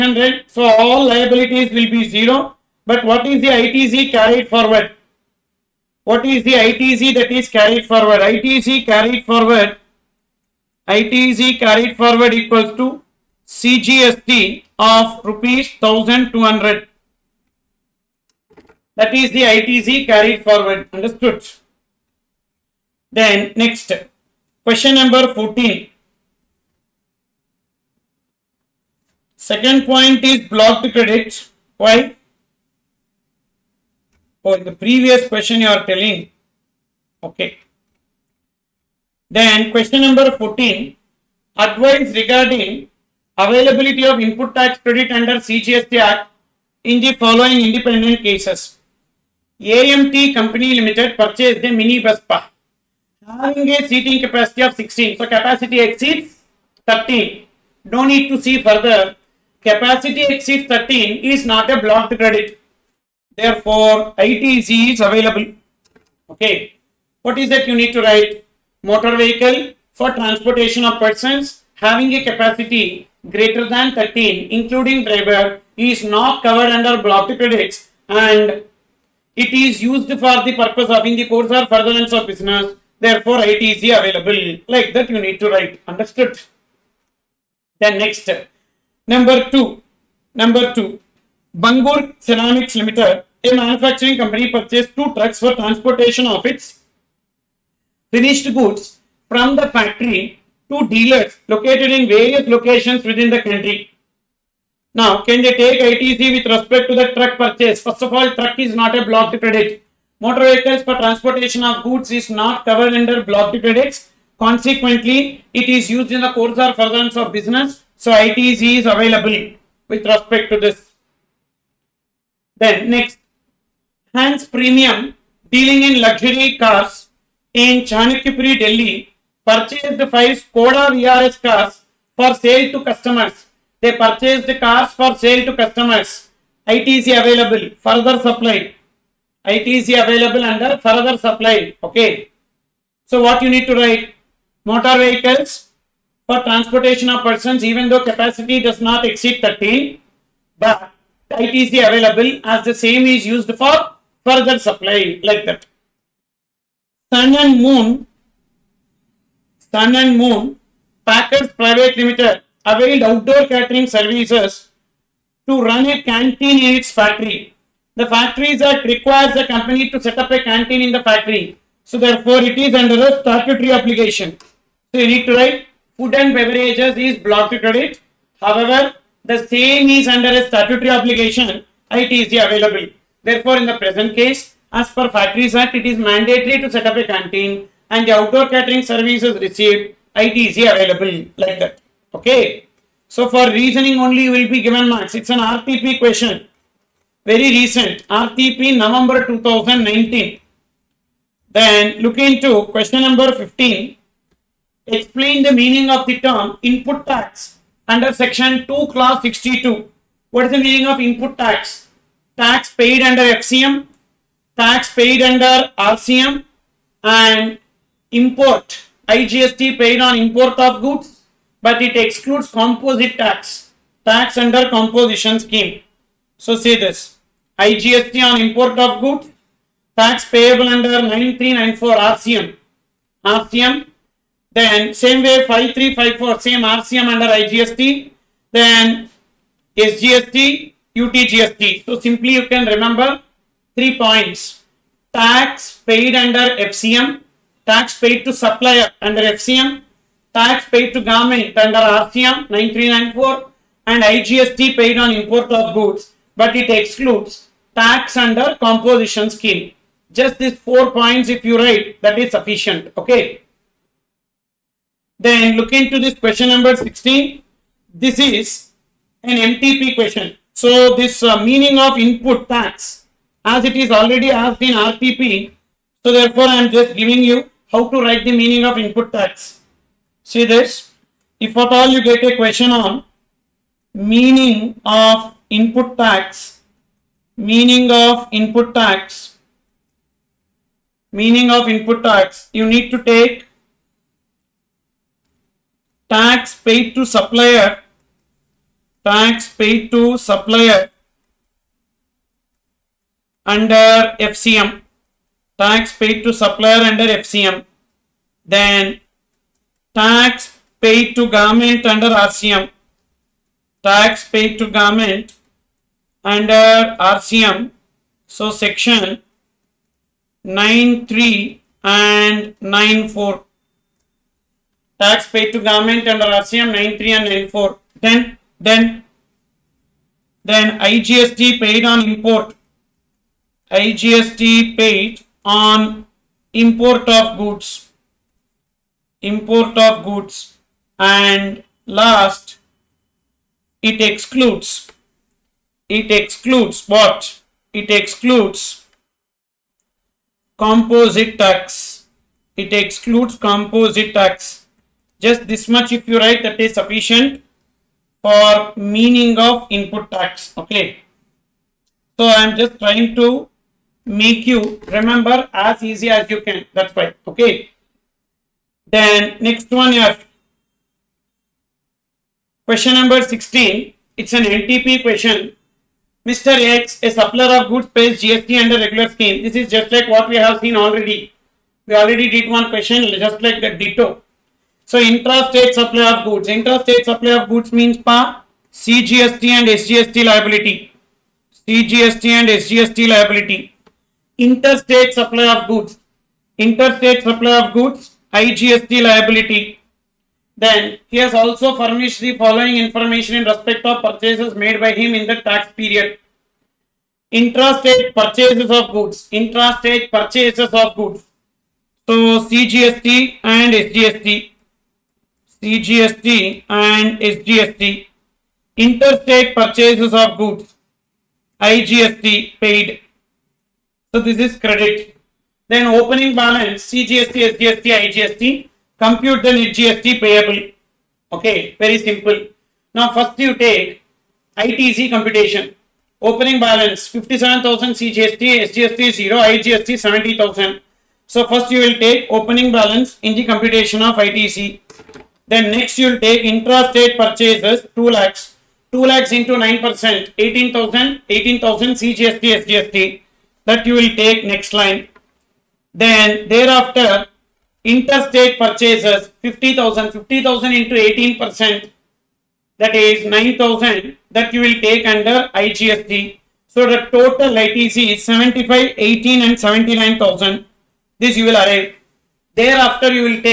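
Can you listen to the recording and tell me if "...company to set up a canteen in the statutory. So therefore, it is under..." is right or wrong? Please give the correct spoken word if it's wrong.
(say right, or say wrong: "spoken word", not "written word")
wrong: "factory", not "statutory".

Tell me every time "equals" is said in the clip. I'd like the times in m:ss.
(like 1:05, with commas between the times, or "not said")
0:12.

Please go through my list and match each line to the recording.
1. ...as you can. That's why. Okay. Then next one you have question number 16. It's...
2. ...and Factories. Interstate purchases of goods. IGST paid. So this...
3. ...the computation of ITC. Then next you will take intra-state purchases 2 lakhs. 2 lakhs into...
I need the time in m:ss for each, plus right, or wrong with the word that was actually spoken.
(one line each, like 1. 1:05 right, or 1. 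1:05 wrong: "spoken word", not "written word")
1. 6:06 right
2. 6:56 wrong: "SGST", not "Factories"
3. 7:23 right.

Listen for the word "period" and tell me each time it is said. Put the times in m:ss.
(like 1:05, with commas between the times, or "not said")
6:45.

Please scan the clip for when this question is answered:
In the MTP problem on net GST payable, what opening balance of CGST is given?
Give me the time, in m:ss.
7:16.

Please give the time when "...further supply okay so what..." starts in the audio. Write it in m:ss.
2:20.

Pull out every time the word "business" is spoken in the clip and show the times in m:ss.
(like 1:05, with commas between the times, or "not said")
1:22, 1:57.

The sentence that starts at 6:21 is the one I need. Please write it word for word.
We already did one question just like the ditto.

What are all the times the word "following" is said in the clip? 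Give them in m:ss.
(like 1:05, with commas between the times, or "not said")
0:47, 6:42.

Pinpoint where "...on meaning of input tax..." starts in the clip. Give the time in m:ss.
4:42.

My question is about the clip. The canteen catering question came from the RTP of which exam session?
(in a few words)
November 2019.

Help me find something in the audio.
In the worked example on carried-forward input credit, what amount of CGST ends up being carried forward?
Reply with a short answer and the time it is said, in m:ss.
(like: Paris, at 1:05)
Rs 1200, at 0:13.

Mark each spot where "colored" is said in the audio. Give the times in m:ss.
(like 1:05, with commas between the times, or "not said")
not said.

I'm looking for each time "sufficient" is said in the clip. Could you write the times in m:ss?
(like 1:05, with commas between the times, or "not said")
4:22, 5:56.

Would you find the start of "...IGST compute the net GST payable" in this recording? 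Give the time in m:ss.
7:08.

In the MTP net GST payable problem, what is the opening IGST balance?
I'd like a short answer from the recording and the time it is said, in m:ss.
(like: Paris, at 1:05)
70,000, at 7:19.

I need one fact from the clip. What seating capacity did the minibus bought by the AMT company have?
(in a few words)
16.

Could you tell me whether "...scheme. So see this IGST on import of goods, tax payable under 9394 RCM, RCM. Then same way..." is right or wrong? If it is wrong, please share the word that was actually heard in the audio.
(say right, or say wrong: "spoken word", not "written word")
right.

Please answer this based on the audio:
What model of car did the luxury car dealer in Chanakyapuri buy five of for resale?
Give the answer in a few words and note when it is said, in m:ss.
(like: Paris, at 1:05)
Skoda VRS, at 2:10.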